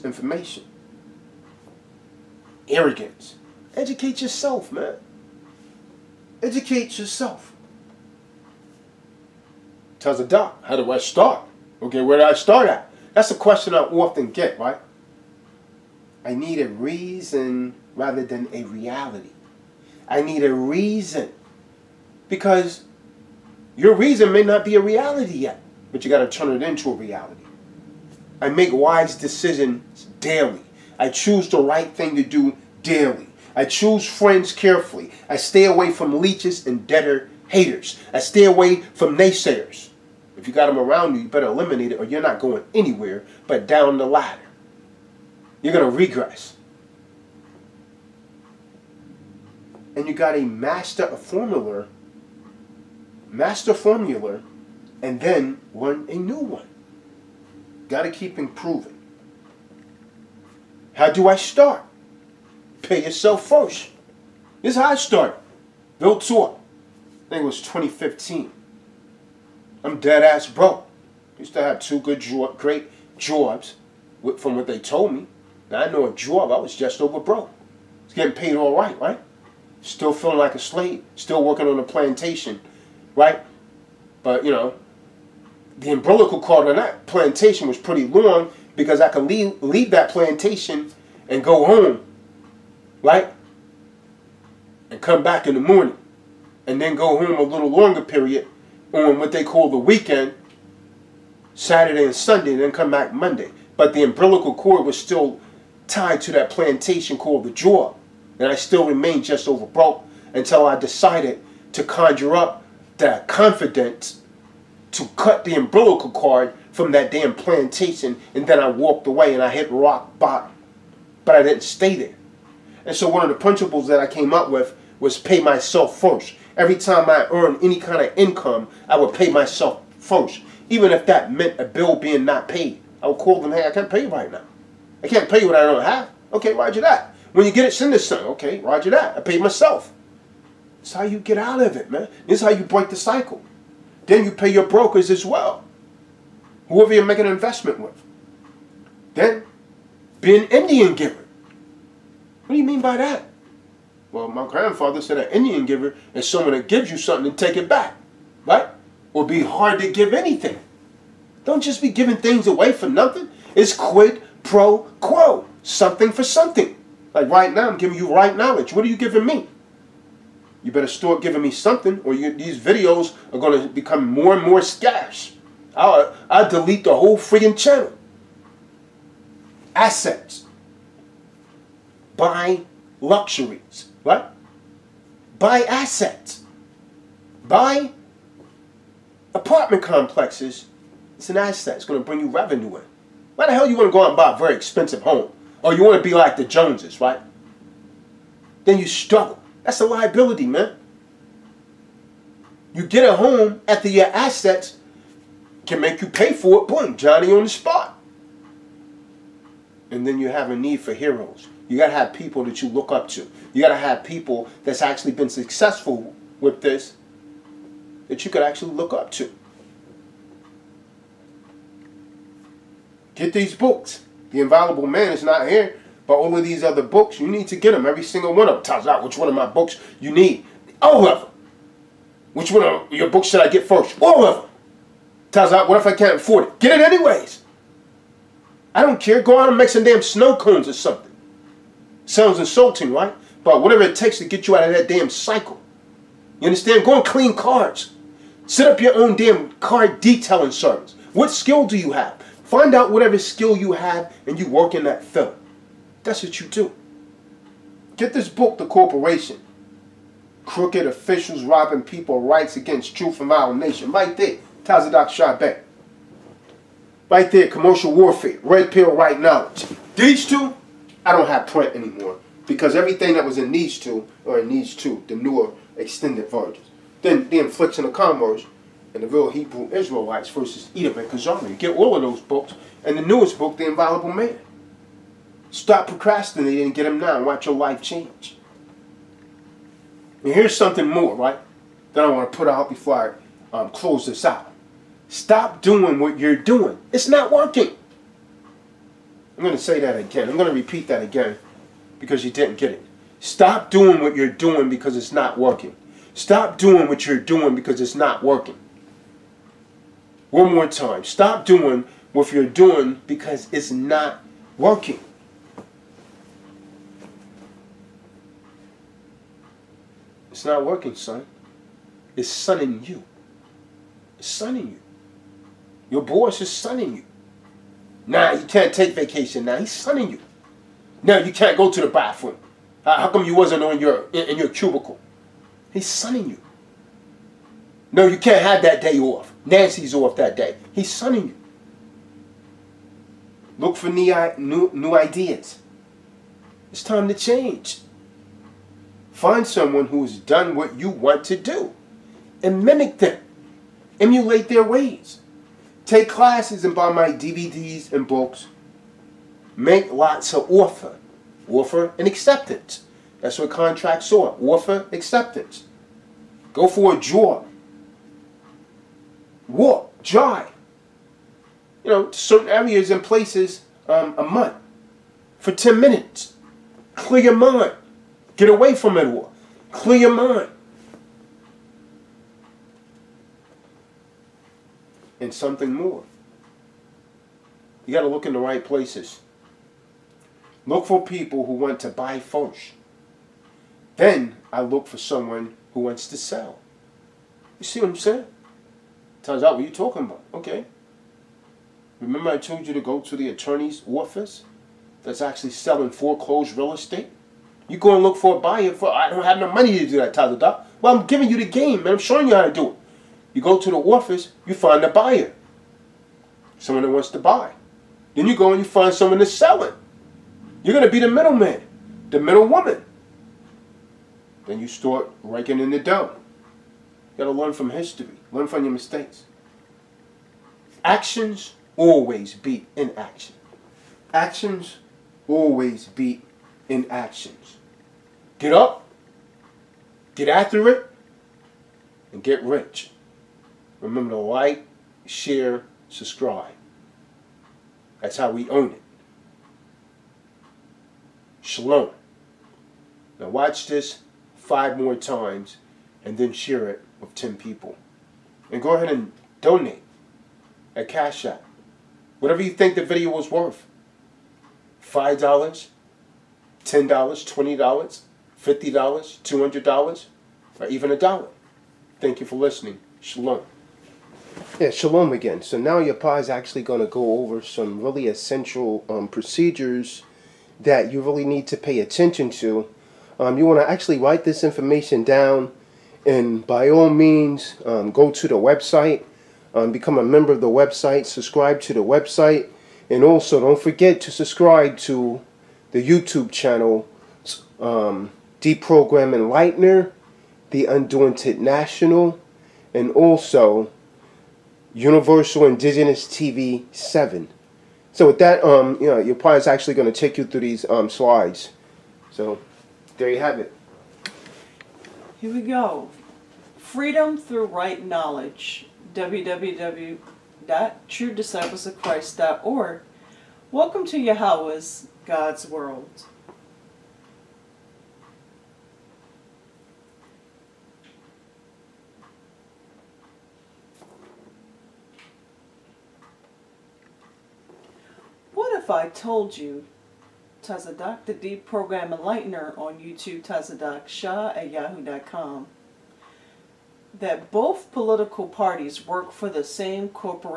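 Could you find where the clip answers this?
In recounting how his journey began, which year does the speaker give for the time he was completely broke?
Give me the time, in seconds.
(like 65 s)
67 s.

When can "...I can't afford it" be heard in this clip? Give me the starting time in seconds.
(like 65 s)
235 s.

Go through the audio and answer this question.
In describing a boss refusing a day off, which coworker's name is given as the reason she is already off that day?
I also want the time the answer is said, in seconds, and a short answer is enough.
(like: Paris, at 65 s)
Nancy, at 339 s.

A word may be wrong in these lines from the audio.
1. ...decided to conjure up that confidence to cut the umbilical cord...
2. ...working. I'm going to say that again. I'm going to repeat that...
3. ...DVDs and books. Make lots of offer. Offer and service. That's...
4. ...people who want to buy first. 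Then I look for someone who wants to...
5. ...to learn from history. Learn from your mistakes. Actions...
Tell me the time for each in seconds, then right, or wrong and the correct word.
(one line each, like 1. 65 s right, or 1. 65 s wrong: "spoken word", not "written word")
1. 110 s right
2. 297 s right
3. 357 s wrong: "acceptance", not "service"
4. 391 s right
5. 427 s right.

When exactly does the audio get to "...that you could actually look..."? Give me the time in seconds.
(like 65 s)
218 s.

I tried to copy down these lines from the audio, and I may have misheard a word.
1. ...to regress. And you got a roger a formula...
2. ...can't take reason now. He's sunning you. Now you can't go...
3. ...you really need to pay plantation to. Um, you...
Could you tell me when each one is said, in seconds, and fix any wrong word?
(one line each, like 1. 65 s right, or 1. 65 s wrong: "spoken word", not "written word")
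1. 45 s wrong: "master", not "roger"
2. 328 s wrong: "vacation", not "reason"
3. 480 s wrong: "attention", not "plantation".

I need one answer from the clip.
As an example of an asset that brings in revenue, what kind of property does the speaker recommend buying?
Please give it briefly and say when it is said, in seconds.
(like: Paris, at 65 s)
Apartment complexes, at 189 s.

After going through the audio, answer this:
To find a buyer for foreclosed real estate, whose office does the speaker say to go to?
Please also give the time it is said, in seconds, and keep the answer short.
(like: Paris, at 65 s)
The attorney's office, at 403 s.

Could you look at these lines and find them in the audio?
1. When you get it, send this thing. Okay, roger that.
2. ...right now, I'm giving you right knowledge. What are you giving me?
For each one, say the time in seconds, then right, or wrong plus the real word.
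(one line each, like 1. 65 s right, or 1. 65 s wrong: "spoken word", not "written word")
1. 137 s right
2. 167 s right.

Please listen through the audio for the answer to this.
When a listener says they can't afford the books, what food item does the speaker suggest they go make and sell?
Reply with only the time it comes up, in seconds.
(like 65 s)
240 s.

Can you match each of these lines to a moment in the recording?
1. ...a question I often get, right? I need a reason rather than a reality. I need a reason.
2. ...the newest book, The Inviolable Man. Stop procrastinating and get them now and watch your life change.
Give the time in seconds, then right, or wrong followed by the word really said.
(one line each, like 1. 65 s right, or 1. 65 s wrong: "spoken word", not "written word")
1. 13 s right
2. 282 s right.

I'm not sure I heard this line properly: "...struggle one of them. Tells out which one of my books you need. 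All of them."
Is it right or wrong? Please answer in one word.
wrong.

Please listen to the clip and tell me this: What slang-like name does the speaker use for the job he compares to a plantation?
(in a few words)
the jaw.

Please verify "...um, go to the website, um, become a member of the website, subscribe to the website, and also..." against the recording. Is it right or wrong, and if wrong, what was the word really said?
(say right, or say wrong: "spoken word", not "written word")
right.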